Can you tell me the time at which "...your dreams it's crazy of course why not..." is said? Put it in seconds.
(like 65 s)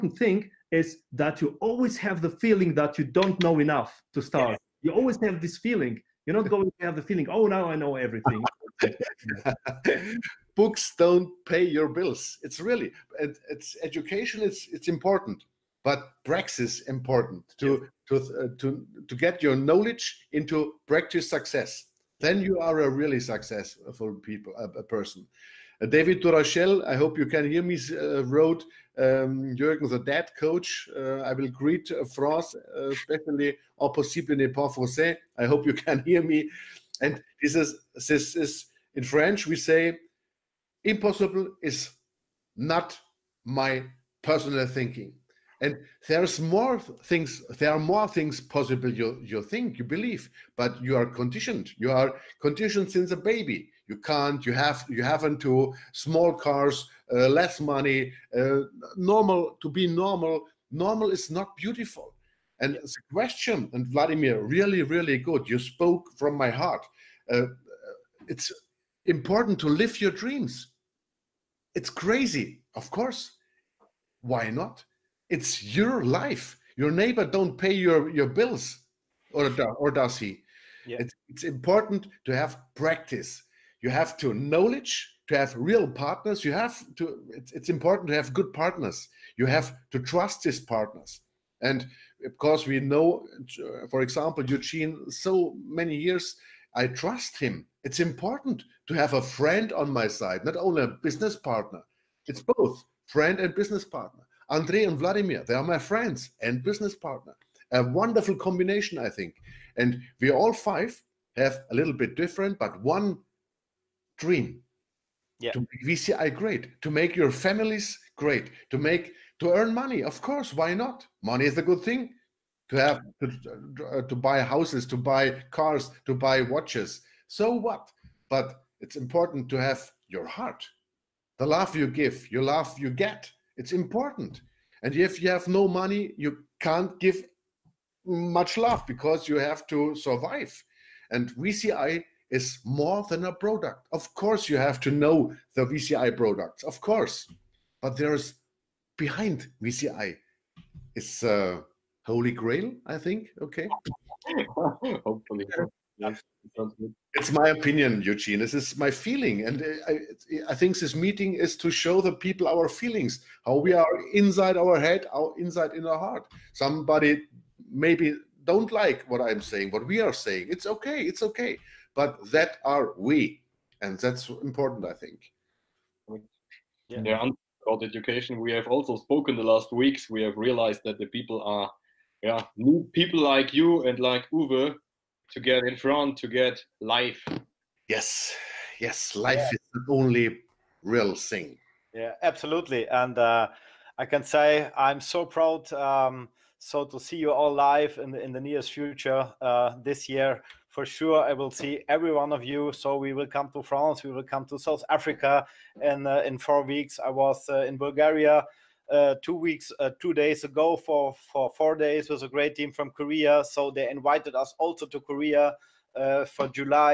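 69 s.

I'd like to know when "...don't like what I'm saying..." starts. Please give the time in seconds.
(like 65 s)
168 s.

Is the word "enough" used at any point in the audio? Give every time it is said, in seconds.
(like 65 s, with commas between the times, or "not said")
3 s.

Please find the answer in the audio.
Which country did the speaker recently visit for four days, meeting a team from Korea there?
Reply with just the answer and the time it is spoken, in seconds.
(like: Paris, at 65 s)
Bulgaria, at 207 s.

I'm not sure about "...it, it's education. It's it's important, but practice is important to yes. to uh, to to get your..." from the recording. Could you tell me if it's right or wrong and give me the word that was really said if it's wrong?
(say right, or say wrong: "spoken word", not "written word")
right.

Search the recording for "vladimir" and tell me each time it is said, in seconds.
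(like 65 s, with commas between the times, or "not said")
63 s, 104 s.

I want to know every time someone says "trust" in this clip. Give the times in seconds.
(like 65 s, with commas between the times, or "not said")
89 s, 96 s.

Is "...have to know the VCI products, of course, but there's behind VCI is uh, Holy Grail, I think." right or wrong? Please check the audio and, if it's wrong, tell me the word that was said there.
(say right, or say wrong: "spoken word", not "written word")
right.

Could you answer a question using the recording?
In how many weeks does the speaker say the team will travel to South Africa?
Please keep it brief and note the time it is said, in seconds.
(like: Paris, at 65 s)
4, at 206 s.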